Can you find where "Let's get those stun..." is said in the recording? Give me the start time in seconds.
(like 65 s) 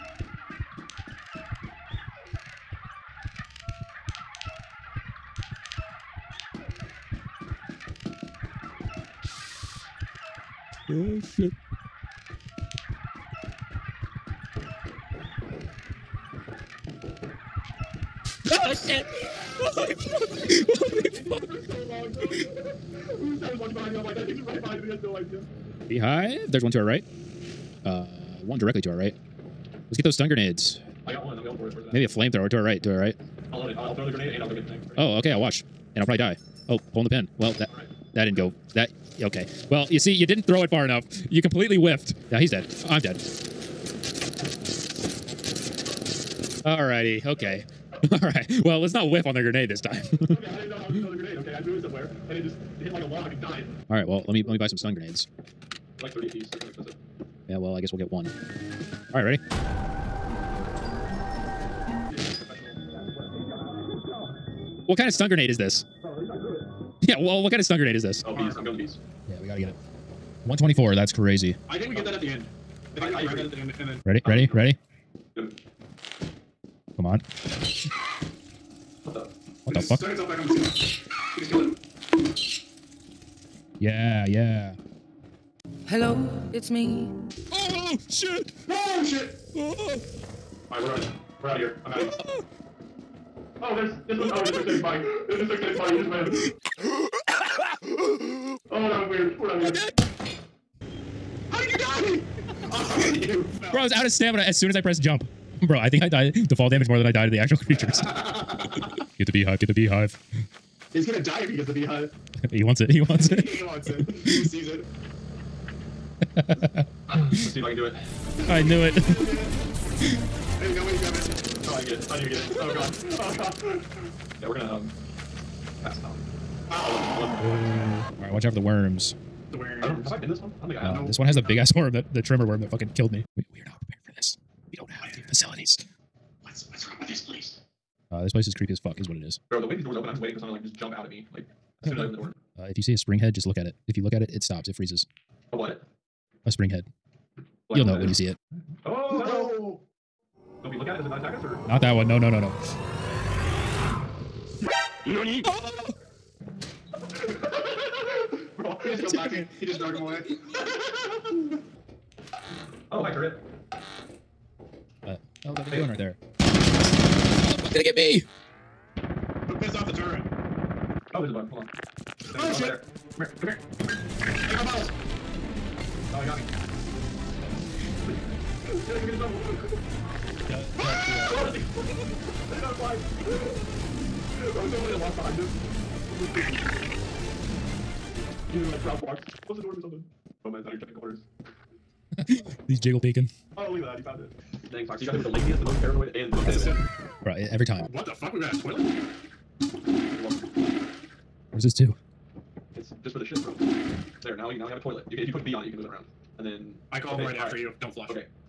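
29 s.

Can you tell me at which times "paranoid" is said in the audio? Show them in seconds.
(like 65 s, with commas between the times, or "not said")
195 s.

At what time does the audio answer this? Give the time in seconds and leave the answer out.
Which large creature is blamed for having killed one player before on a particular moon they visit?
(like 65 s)
132 s.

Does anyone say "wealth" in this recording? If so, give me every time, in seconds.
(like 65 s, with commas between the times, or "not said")
not said.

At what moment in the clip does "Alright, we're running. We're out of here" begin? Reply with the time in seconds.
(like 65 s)
90 s.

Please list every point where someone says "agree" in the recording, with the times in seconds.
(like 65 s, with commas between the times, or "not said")
73 s.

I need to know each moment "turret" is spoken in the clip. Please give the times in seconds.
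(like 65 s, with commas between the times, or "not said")
163 s, 169 s.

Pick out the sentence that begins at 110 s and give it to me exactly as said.
He's gonna die if he gets the beehive.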